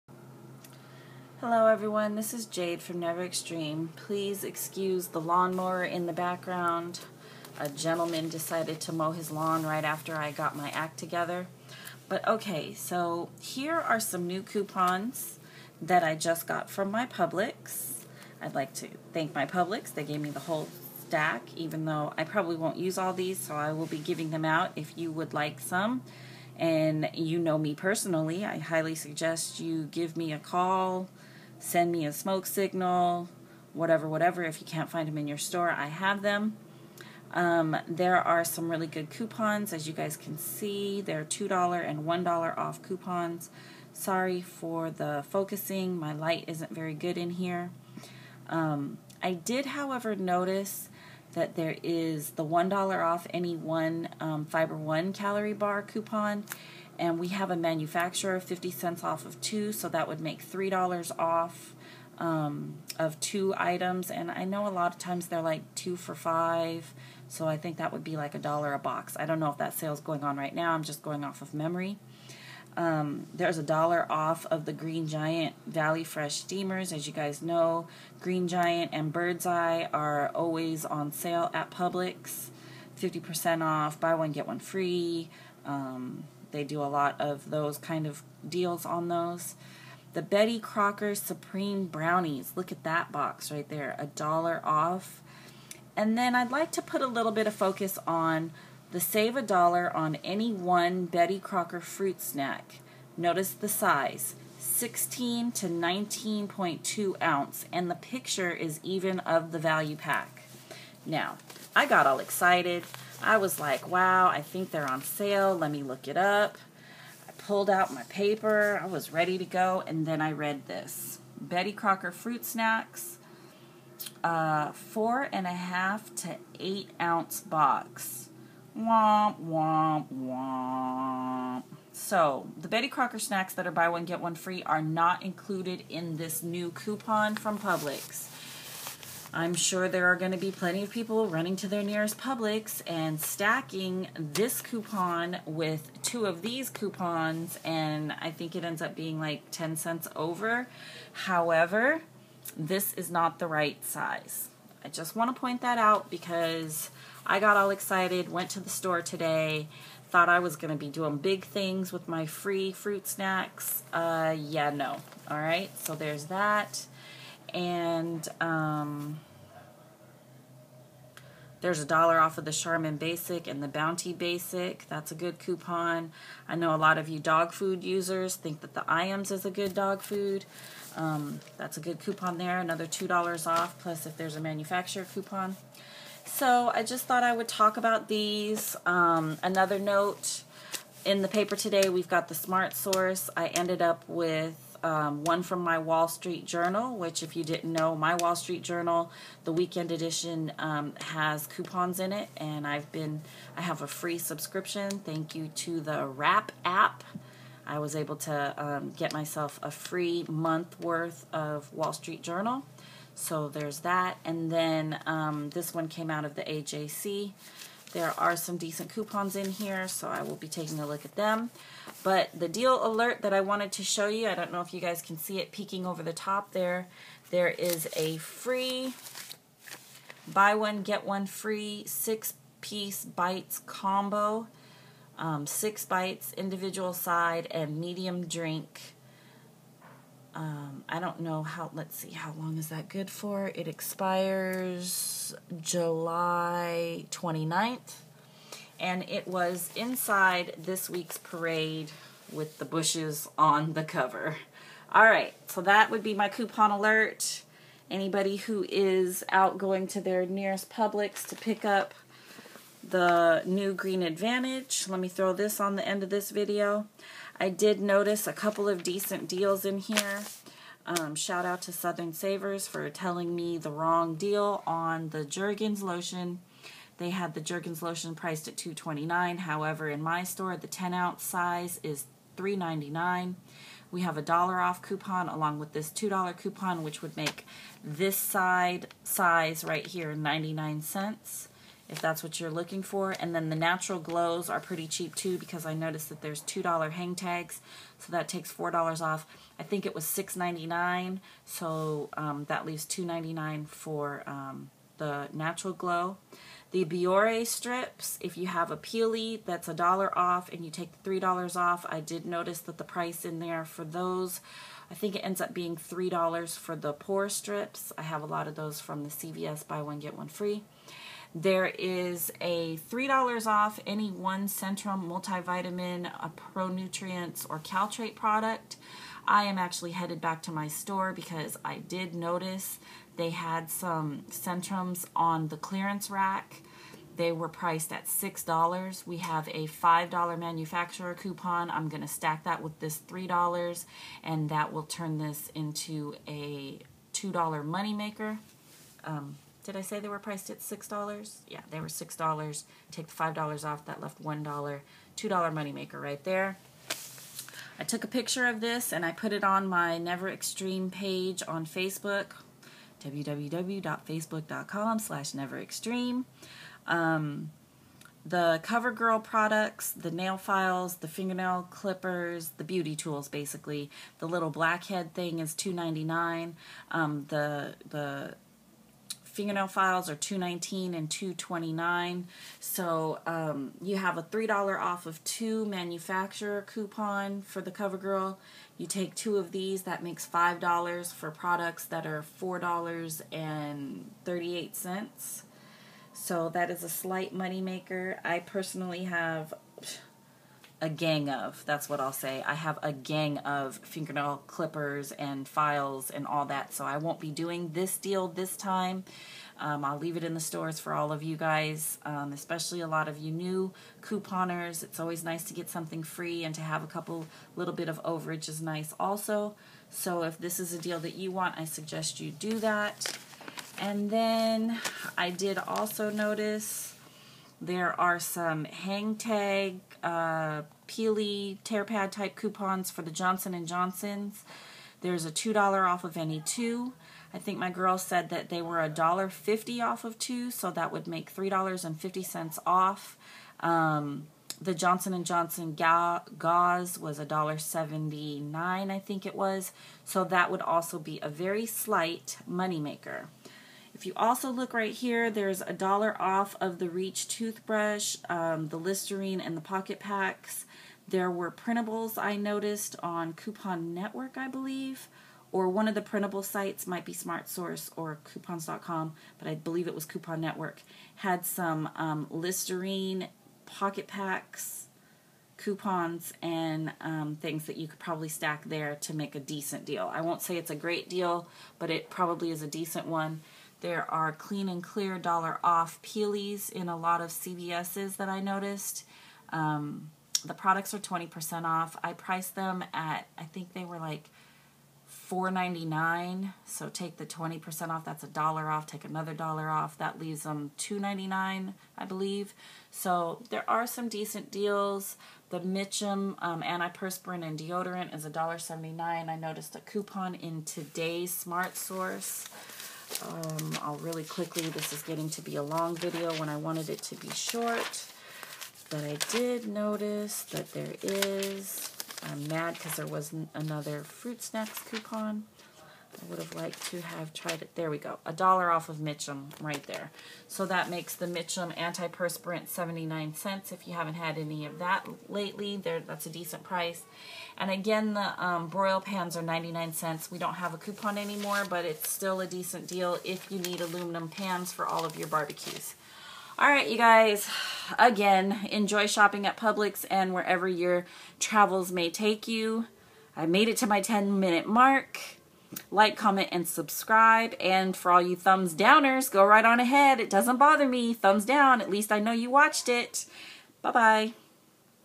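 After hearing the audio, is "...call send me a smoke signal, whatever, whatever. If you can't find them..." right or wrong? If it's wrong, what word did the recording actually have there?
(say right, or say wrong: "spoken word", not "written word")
right.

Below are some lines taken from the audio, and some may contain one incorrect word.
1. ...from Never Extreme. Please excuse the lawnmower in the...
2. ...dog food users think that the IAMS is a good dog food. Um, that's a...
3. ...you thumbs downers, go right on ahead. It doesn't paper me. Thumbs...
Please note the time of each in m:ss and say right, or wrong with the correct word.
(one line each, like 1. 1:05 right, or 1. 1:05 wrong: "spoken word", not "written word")
1. 0:02 right
2. 2:57 right
3. 9:18 wrong: "bother", not "paper".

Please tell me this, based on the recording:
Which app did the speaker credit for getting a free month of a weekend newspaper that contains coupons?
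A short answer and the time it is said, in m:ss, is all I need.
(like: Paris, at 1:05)
Wrap app, at 3:26.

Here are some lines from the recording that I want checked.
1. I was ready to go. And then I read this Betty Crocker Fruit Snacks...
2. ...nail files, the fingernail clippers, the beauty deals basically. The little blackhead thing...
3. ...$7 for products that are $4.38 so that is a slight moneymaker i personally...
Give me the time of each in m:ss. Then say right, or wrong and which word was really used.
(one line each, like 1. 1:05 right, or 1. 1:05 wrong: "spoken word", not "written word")
1. 1:58 right
2. 6:10 wrong: "tools", not "deals"
3. 6:30 wrong: "5", not "7".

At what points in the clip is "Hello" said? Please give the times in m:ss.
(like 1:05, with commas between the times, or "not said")
0:01.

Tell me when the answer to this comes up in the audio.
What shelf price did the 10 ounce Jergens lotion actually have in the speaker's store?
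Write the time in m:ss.
4:42.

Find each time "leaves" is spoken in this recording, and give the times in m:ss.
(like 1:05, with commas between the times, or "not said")
5:02, 6:49, 8:20.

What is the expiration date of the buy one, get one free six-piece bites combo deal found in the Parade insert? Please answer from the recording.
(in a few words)
July 29th.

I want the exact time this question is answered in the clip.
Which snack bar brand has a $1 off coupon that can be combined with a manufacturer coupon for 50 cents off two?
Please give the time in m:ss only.
0:54.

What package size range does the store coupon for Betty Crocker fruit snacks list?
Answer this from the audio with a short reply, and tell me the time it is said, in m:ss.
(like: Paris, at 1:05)
16 to 19.2 ounce, at 1:44.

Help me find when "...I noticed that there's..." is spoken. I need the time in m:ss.
4:55.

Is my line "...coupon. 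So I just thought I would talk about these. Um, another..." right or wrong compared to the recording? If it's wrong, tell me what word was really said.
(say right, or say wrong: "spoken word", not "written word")
right.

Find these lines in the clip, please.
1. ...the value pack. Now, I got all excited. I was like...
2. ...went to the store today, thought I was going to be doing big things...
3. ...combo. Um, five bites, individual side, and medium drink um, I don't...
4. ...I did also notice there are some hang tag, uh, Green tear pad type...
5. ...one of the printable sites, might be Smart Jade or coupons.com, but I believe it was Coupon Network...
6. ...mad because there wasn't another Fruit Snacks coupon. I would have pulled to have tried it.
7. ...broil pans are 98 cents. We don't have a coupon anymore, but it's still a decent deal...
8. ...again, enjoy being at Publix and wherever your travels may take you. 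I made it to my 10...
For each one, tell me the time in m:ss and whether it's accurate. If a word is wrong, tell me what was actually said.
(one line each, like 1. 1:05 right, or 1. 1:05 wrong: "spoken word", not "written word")
1. 1:49 right
2. 2:38 right
3. 3:53 wrong: "six", not "five"
4. 7:05 wrong: "Peely", not "Green"
5. 7:45 wrong: "Source", not "Jade"
6. 8:42 wrong: "liked", not "pulled"
7. 8:58 wrong: "99", not "98"
8. 9:07 wrong: "shopping", not "being".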